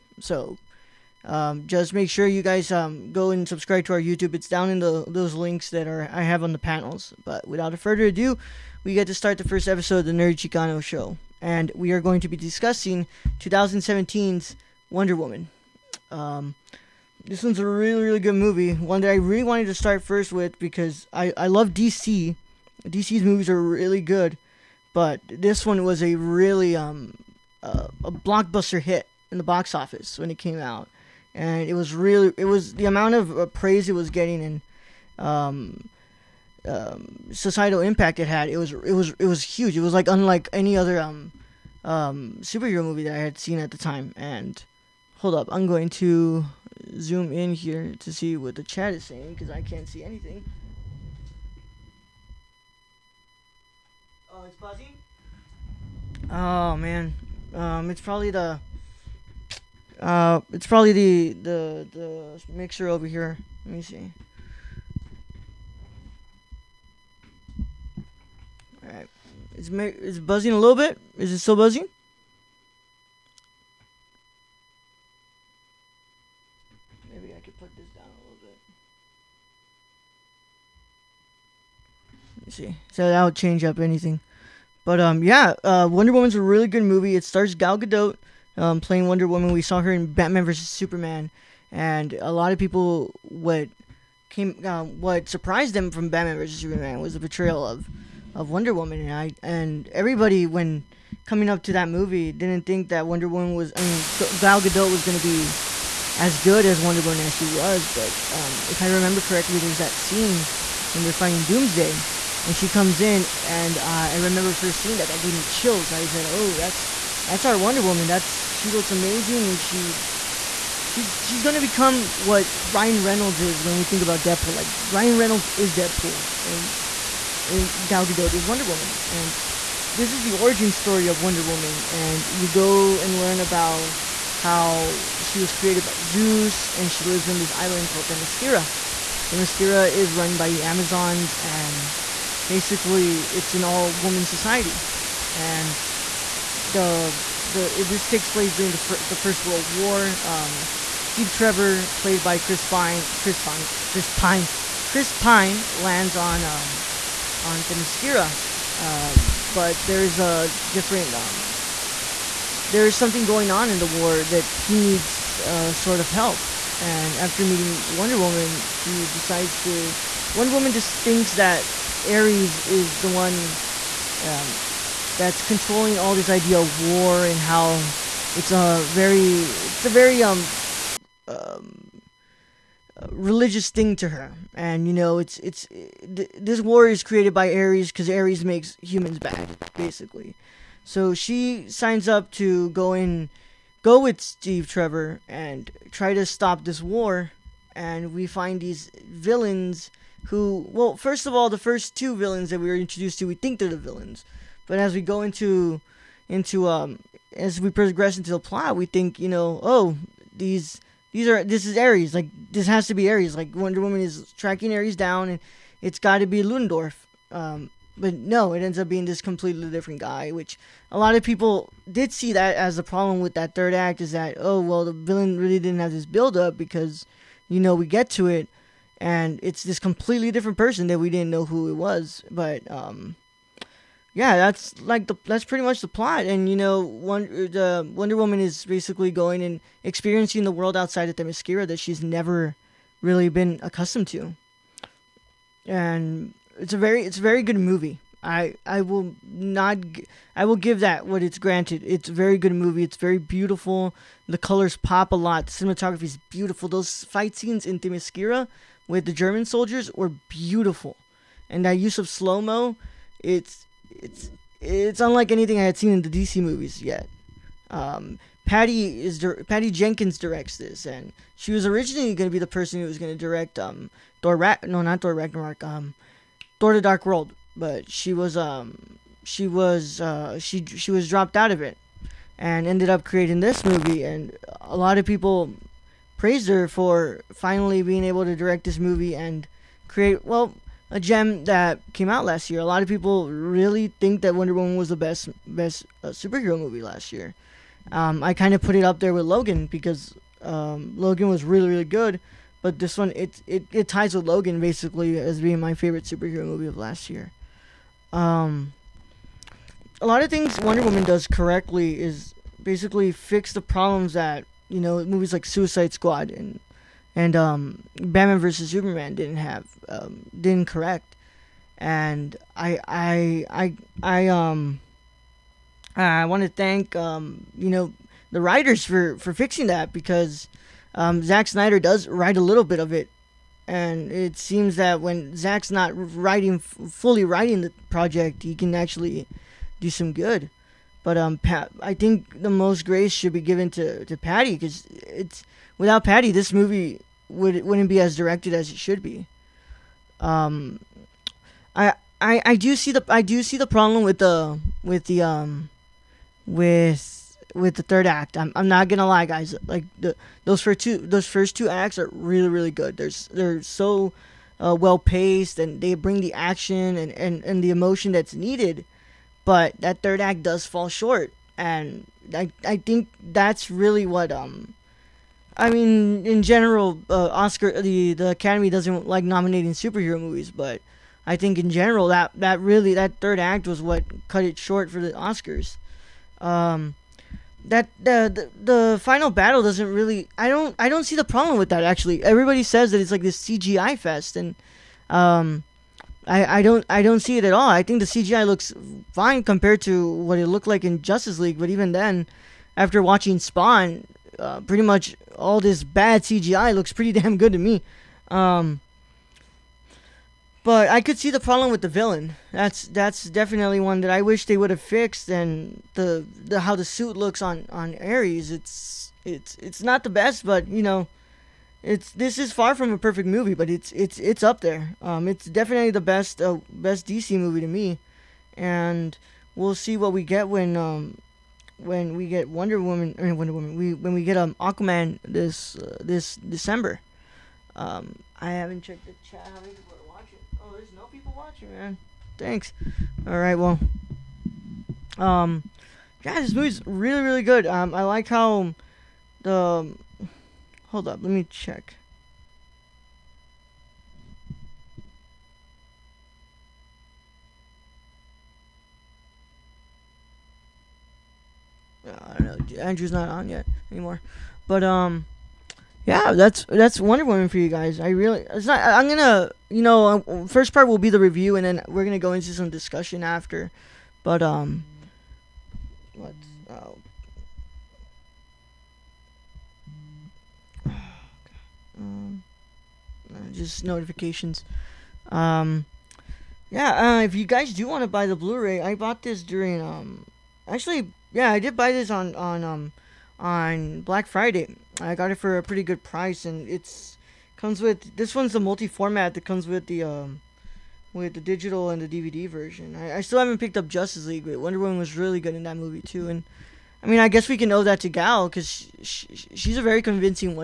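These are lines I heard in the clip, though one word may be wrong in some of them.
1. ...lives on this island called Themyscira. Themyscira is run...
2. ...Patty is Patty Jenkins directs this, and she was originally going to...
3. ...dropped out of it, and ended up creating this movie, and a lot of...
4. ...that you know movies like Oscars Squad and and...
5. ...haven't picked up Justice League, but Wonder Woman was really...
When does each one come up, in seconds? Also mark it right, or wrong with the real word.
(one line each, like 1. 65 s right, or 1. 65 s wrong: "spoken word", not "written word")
1. 137 s right
2. 268 s right
3. 281 s right
4. 314 s wrong: "Suicide", not "Oscars"
5. 503 s right.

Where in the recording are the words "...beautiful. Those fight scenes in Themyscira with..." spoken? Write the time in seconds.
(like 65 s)
256 s.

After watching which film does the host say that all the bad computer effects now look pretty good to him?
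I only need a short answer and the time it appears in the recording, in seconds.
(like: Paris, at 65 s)
Spawn, at 403 s.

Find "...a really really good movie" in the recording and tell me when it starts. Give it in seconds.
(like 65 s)
17 s.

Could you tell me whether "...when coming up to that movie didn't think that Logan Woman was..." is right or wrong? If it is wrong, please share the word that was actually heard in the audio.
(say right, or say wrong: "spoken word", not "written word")
wrong: "Wonder", not "Logan".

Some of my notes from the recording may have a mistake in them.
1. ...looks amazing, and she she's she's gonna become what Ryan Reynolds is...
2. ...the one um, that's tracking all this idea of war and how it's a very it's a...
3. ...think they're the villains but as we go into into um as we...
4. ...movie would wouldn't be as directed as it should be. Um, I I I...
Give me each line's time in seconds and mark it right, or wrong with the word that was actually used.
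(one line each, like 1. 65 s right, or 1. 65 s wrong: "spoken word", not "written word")
1. 118 s right
2. 172 s wrong: "controlling", not "tracking"
3. 203 s right
4. 346 s right.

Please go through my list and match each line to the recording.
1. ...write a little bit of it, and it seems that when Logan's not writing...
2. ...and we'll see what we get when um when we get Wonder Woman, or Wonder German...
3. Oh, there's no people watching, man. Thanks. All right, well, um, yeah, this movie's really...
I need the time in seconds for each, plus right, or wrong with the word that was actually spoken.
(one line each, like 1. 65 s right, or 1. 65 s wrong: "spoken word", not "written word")
1. 332 s wrong: "Zack", not "Logan"
2. 428 s wrong: "Woman", not "German"
3. 440 s right.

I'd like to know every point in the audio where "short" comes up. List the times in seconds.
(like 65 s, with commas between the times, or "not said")
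370 s, 384 s.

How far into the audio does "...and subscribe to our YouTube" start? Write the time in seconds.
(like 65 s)
3 s.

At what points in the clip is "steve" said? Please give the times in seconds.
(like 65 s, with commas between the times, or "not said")
151 s, 194 s.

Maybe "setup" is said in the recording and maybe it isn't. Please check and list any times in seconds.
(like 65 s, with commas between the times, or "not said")
not said.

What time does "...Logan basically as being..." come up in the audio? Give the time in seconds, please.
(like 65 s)
304 s.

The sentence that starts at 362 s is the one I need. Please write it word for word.
They're they're so uh, well paced and they bring the action and, and and the emotion that's needed.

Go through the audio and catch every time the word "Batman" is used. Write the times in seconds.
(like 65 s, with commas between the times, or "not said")
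90 s, 96 s, 317 s.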